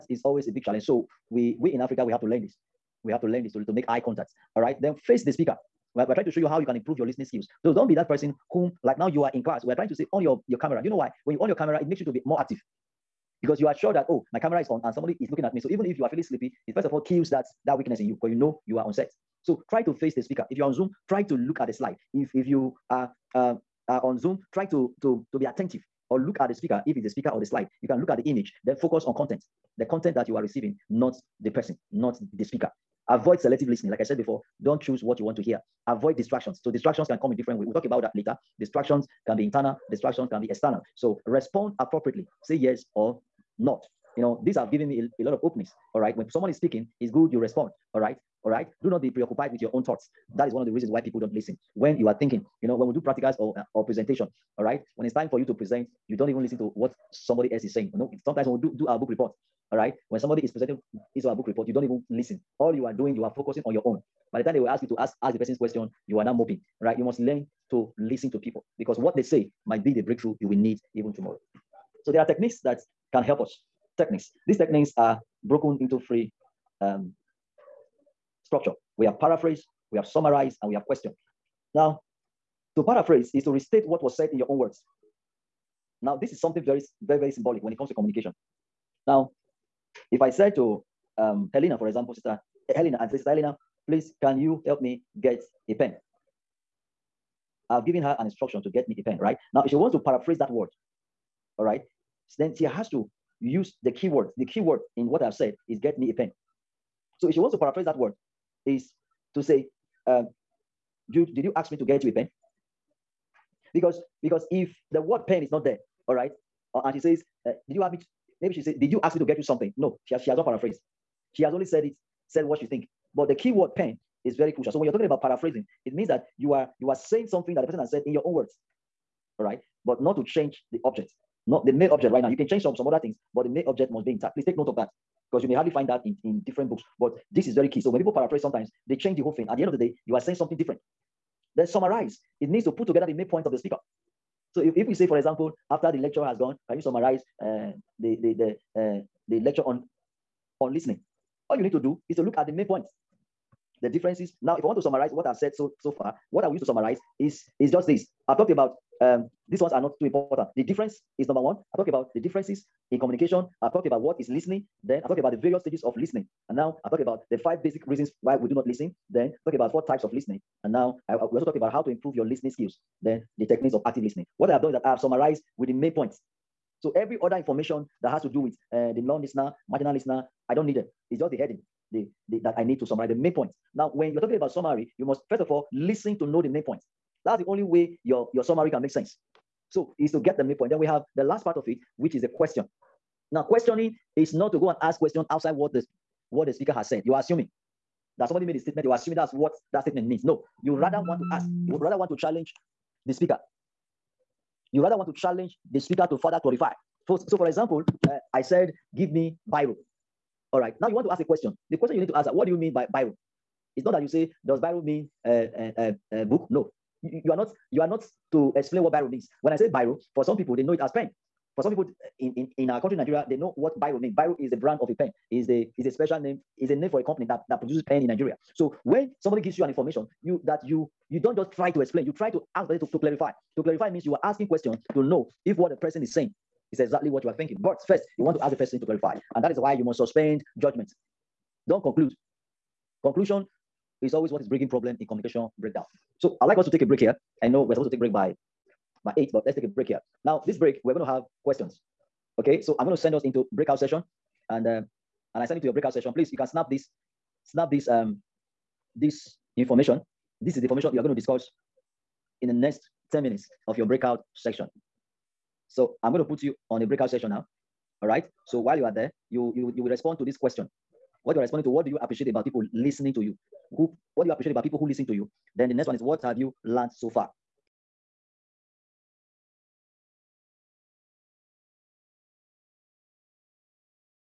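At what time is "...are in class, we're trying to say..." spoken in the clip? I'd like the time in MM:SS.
00:09.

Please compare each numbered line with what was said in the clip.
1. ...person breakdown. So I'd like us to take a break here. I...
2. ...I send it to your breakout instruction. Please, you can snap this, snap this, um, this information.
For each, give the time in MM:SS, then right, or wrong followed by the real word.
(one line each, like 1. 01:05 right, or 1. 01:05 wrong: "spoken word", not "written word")
1. 04:05 wrong: "communication", not "person"
2. 04:15 wrong: "session", not "instruction".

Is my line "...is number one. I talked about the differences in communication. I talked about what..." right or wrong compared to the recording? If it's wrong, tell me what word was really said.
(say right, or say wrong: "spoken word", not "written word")
right.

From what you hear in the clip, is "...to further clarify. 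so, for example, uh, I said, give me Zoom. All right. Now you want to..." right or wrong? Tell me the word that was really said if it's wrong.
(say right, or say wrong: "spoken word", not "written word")
wrong: "Biro", not "Zoom".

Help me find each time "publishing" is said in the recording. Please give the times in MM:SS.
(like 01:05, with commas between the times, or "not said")
not said.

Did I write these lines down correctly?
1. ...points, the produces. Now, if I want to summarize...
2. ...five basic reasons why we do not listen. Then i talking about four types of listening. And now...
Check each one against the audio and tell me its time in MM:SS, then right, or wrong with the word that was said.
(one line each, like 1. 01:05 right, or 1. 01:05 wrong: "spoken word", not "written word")
1. 02:32 wrong: "differences", not "produces"
2. 02:47 right.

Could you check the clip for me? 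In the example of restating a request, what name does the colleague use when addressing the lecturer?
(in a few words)
Jude.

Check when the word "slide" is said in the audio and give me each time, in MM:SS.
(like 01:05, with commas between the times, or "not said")
00:21, 00:27.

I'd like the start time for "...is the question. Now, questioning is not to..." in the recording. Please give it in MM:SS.
03:12.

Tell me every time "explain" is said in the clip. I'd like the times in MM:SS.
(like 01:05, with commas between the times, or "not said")
03:38, 03:51.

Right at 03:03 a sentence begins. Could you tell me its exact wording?
Now, when you're talking about summary, you must first of all listen to know the main point.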